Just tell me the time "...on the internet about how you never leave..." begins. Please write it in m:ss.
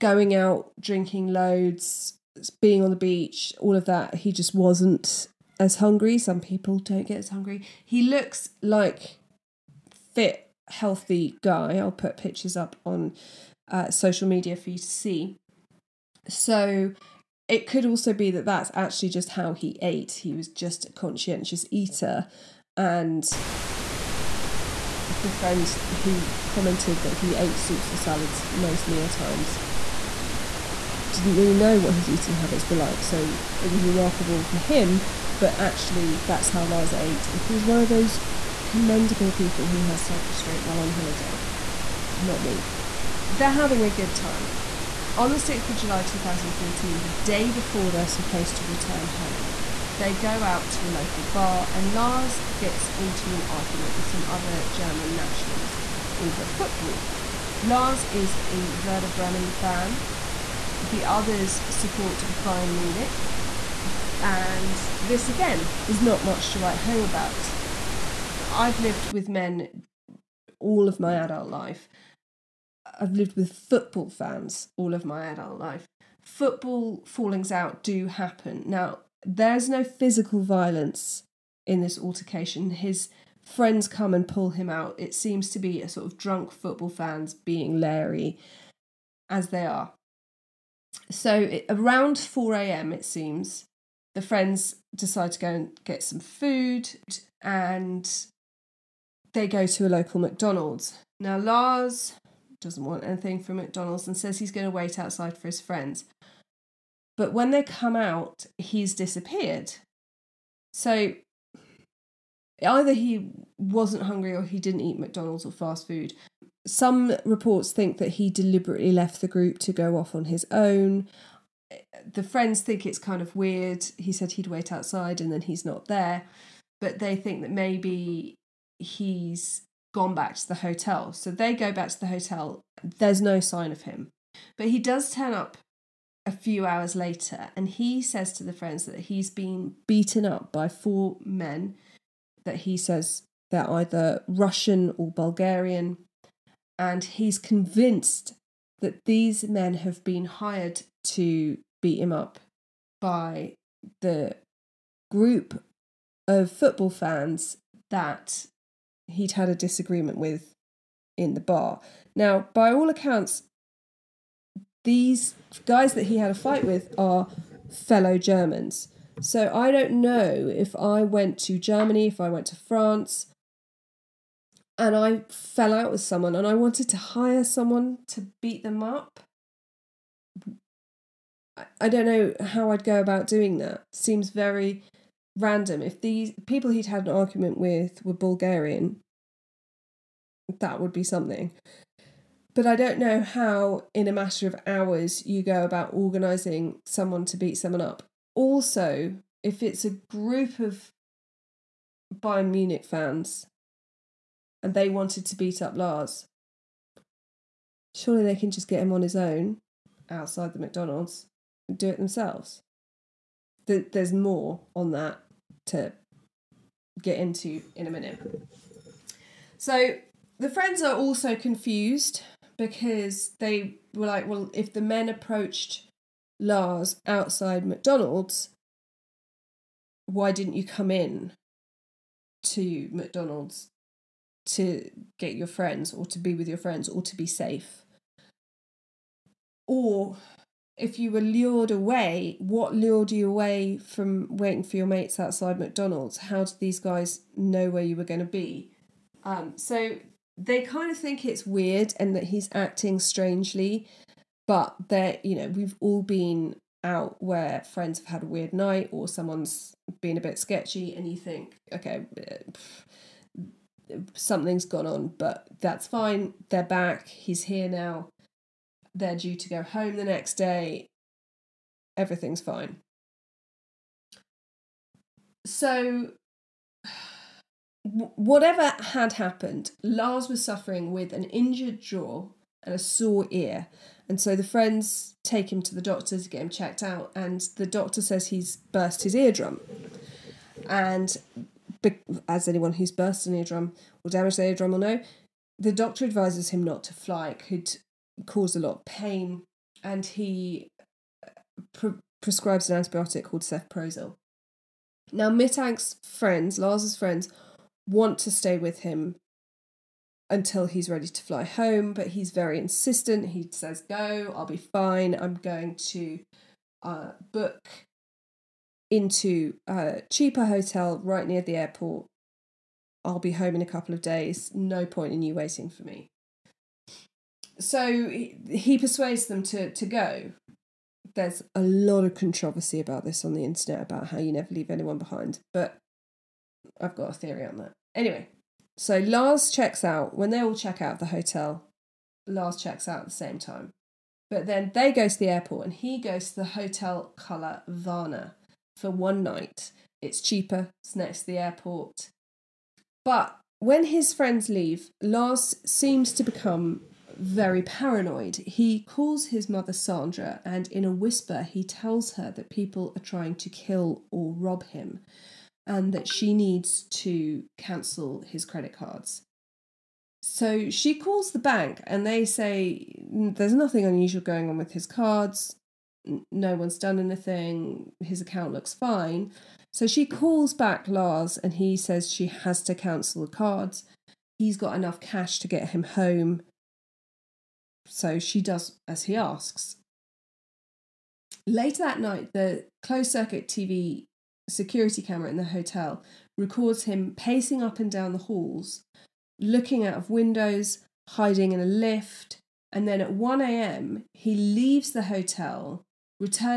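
5:33.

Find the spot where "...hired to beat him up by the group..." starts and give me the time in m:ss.
2:30.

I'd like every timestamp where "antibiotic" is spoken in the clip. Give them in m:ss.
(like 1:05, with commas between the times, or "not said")
5:02.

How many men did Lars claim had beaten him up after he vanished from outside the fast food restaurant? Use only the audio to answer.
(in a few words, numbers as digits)
4.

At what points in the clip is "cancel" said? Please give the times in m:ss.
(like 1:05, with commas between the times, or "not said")
6:07, 6:22.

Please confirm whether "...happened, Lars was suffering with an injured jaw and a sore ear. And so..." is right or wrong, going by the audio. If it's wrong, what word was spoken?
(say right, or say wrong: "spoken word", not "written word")
right.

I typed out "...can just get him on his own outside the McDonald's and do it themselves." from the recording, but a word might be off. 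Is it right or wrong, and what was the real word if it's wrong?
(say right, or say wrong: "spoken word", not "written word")
right.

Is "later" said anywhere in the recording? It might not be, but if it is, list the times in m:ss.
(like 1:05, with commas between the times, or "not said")
2:16, 6:31.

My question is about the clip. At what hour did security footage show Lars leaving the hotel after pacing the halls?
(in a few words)
1 a.m.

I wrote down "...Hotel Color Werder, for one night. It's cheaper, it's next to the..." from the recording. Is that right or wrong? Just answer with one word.
wrong.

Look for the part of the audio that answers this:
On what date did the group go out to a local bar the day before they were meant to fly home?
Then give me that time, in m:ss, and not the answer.
0:45.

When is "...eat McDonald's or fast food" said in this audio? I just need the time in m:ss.
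1:54.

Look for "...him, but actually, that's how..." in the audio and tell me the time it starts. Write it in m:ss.
0:34.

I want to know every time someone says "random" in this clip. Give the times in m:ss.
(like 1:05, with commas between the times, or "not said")
3:05.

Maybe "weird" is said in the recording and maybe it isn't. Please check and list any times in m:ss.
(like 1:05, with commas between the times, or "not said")
2:03, 4:11, 4:18.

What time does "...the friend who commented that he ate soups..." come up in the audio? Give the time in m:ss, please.
0:25.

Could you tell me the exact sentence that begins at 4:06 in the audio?
How did these guys know where you were going to be?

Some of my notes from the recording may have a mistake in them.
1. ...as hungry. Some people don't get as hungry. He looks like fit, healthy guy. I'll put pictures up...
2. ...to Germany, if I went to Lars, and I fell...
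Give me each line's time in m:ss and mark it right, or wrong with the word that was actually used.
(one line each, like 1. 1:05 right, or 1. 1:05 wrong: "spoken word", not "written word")
1. 0:05 right
2. 2:51 wrong: "France", not "Lars".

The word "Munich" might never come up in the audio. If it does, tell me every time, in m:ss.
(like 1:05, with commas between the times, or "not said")
1:02, 3:22.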